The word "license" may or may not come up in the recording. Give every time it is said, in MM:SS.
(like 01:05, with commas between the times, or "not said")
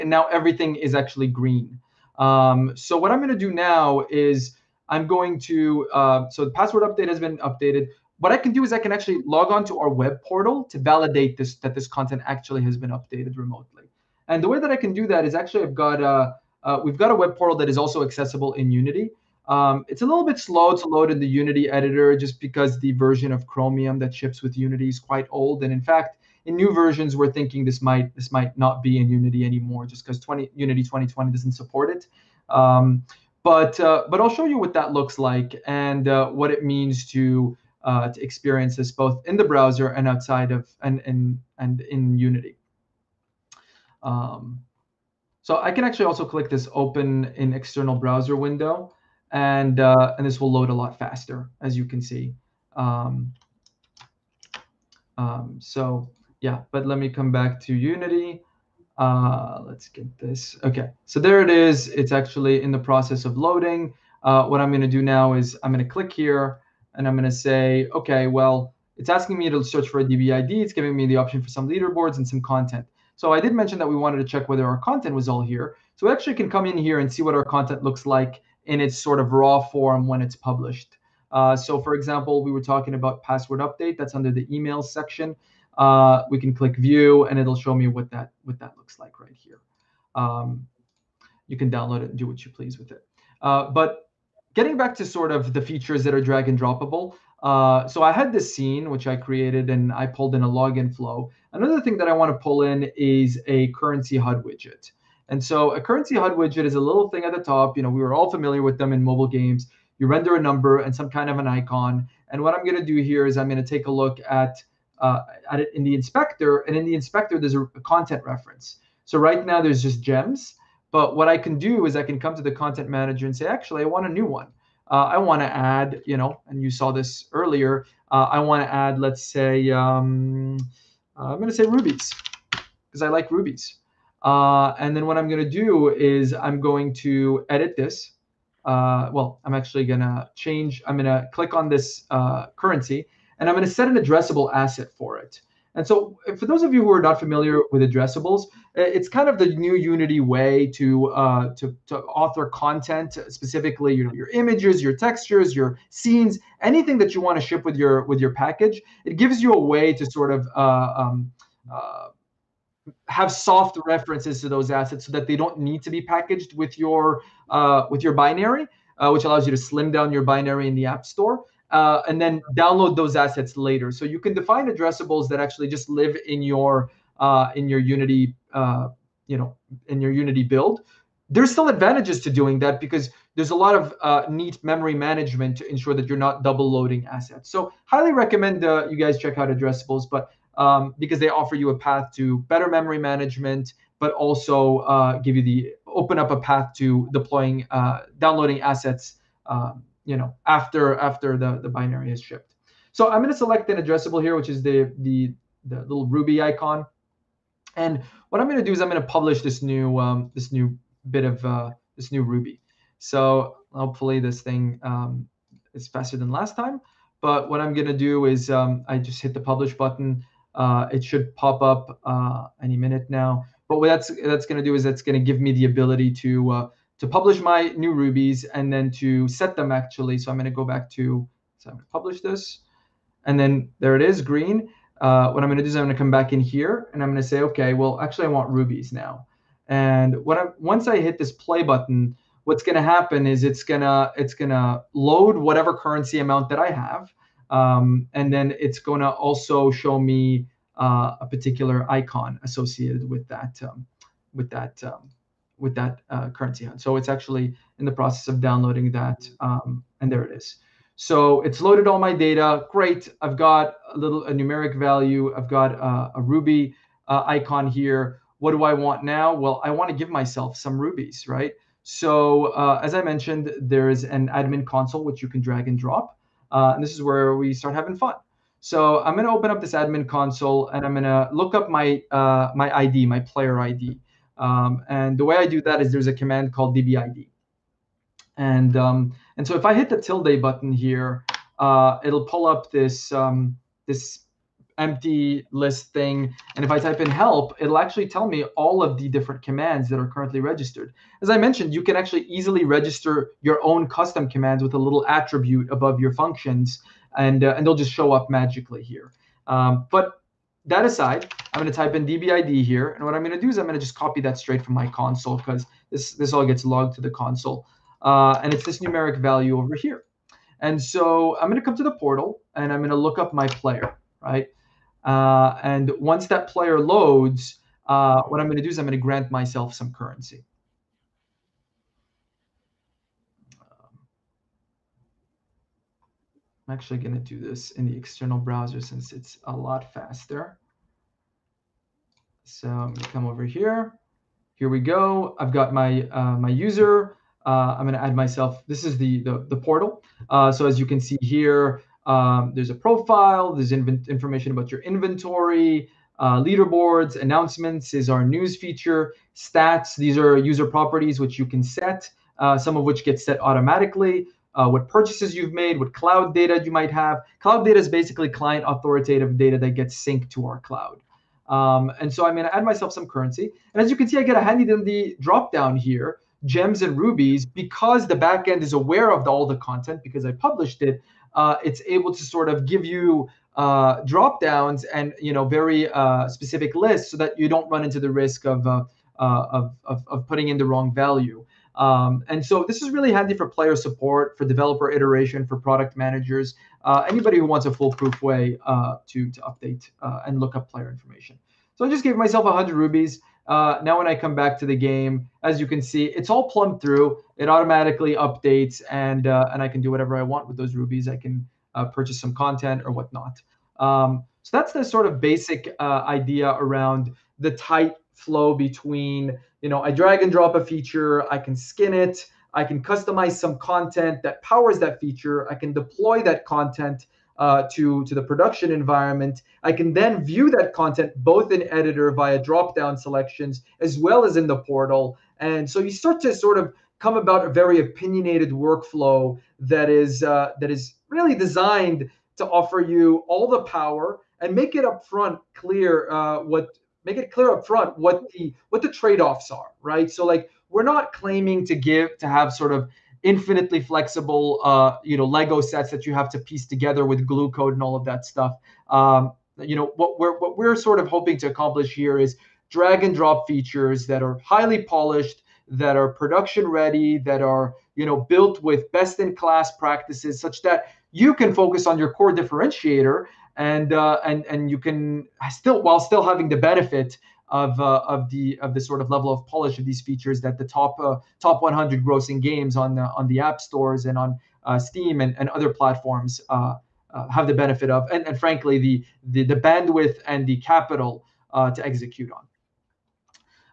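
not said.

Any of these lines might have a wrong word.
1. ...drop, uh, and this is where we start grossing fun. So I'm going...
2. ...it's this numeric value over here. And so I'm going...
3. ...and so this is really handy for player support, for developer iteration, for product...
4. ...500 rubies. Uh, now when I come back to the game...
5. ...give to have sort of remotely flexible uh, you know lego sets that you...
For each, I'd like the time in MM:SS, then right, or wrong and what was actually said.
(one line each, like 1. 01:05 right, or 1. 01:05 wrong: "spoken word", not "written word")
1. 04:35 wrong: "having", not "grossing"
2. 05:18 right
3. 06:32 right
4. 06:42 wrong: "100", not "500"
5. 07:31 wrong: "infinitely", not "remotely".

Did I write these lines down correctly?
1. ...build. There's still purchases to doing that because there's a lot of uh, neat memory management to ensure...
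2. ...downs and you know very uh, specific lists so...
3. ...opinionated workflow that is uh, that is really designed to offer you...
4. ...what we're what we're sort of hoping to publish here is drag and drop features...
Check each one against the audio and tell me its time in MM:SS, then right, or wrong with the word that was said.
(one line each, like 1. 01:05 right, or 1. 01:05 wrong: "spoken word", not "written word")
1. 03:00 wrong: "advantages", not "purchases"
2. 06:24 right
3. 07:17 right
4. 07:39 wrong: "accomplish", not "publish".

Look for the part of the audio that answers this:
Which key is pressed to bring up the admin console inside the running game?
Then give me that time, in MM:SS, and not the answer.
04:50.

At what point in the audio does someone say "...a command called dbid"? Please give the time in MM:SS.
04:46.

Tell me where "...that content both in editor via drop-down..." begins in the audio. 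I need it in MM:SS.
07:10.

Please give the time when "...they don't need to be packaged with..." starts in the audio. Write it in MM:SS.
02:45.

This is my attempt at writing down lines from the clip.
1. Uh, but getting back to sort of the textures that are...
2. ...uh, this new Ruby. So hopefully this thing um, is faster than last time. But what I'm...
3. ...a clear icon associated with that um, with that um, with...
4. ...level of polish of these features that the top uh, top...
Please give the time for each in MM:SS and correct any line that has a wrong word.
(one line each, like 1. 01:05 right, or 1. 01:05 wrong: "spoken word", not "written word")
1. 01:33 wrong: "features", not "textures"
2. 03:31 right
3. 04:11 wrong: "particular", not "clear"
4. 07:59 right.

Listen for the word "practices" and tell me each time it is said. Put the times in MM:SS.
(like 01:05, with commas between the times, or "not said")
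07:49.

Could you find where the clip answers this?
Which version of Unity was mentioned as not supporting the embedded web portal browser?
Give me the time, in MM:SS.
00:30.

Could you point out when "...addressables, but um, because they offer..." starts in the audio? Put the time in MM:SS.
03:09.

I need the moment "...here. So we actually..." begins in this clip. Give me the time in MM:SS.
01:15.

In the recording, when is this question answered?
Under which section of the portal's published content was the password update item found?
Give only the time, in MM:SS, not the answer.
01:24.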